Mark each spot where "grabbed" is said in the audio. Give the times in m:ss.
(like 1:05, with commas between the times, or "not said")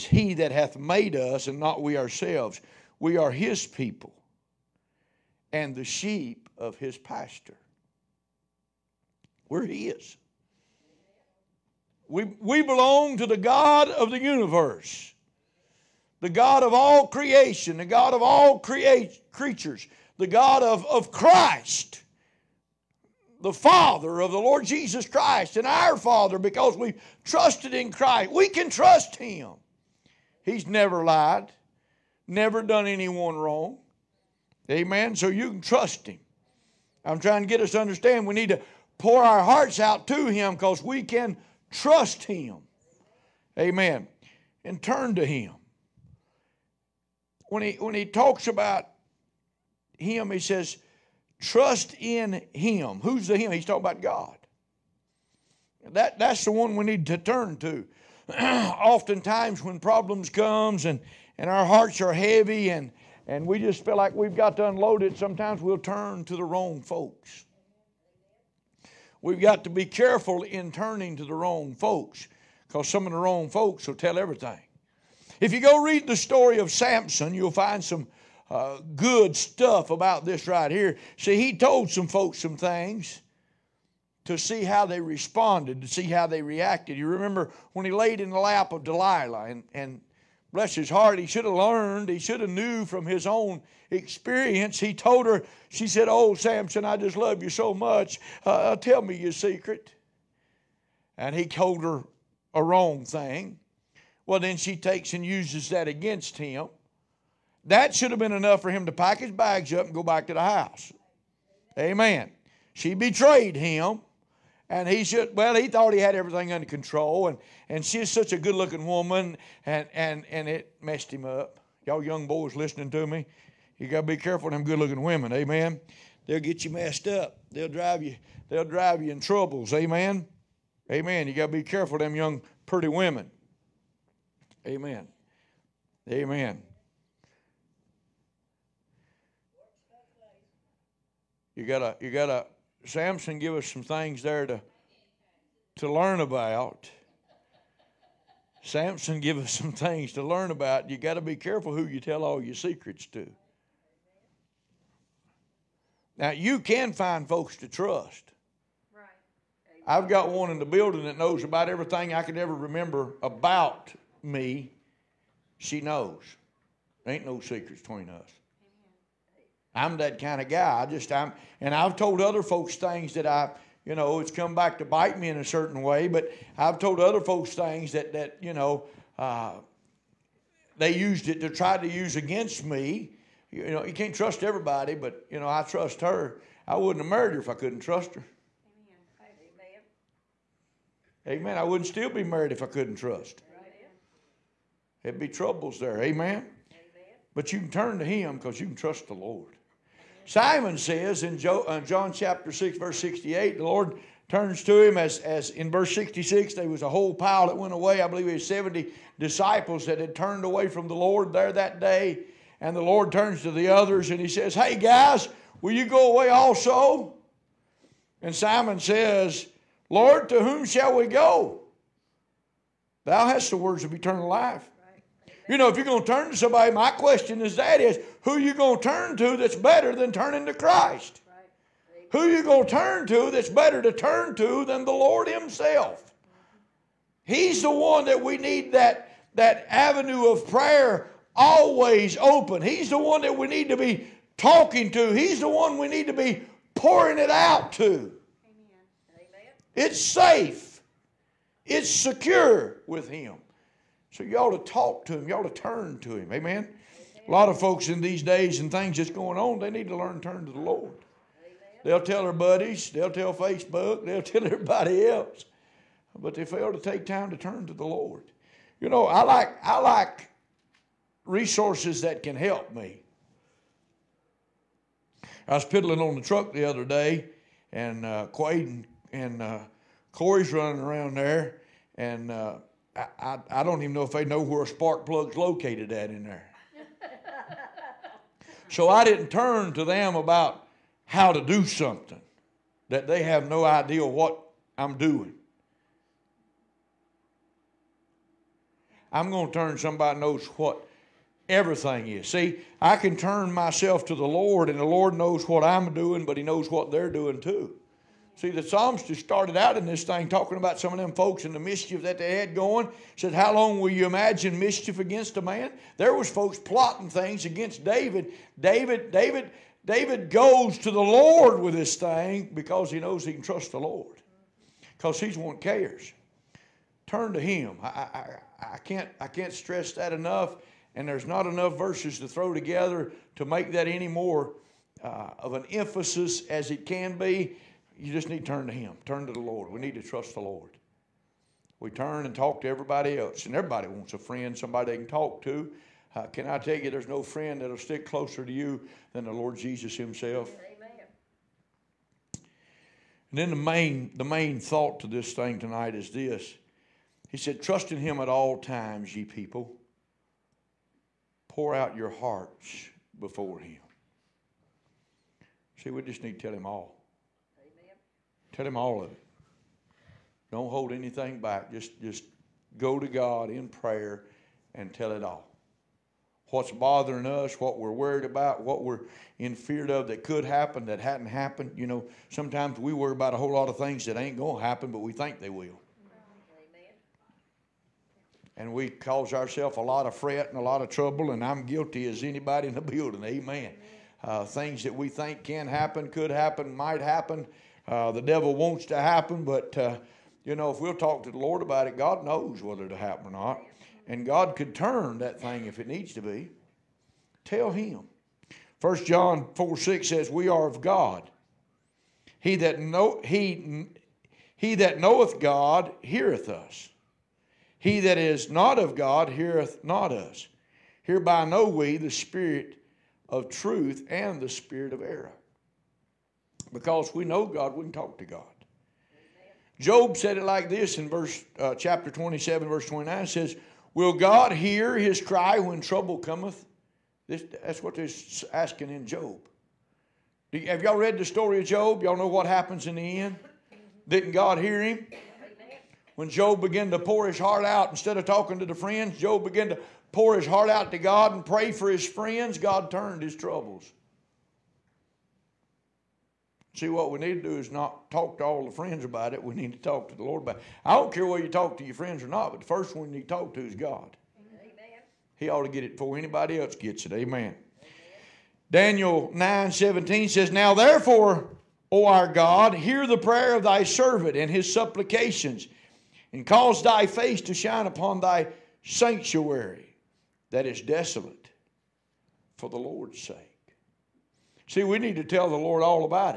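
not said.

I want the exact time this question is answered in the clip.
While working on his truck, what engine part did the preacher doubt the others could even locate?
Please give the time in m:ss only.
4:44.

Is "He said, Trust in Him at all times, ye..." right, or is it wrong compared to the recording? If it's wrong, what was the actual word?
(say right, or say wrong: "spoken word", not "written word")
right.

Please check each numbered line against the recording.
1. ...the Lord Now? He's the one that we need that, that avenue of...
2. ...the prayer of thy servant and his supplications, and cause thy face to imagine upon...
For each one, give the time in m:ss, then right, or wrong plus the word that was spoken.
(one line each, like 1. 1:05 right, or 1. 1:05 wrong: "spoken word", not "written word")
1. 3:54 wrong: "Himself", not "Now"
2. 7:53 wrong: "shine", not "imagine".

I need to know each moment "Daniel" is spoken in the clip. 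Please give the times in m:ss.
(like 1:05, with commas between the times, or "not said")
7:48.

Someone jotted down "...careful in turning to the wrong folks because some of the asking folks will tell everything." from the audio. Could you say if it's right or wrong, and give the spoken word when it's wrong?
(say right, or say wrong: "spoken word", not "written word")
wrong: "wrong", not "asking".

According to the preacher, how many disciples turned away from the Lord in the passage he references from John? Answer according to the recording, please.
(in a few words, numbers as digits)
70.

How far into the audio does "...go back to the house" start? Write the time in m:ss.
1:49.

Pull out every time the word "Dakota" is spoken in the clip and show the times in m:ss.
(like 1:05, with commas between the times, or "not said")
not said.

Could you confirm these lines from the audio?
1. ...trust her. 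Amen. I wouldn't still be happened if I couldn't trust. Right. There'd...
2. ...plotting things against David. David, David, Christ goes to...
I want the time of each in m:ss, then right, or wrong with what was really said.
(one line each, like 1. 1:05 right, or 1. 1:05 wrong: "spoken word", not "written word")
1. 3:07 wrong: "married", not "happened"
2. 5:16 wrong: "David", not "Christ".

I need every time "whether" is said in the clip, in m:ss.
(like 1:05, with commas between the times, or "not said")
6:42, 7:41.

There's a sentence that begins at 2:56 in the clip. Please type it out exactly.
But I've told other folks things that that you know uh, they used it to try to use against me.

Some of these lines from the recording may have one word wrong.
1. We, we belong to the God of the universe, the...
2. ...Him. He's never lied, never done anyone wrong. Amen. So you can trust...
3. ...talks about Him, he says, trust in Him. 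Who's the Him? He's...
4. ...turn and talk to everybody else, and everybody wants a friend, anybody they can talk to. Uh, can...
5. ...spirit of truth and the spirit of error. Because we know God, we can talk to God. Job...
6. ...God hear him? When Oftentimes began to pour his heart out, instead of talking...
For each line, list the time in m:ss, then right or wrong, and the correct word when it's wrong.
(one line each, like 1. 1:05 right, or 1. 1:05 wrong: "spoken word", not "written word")
1. 0:12 right
2. 0:29 right
3. 0:48 right
4. 5:41 wrong: "somebody", not "anybody"
5. 7:02 right
6. 7:24 wrong: "Job", not "Oftentimes".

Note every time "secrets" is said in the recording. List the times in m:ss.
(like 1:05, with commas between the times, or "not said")
1:39, 2:32, 2:47.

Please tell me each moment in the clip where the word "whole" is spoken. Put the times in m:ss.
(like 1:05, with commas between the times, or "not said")
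3:26, 6:23.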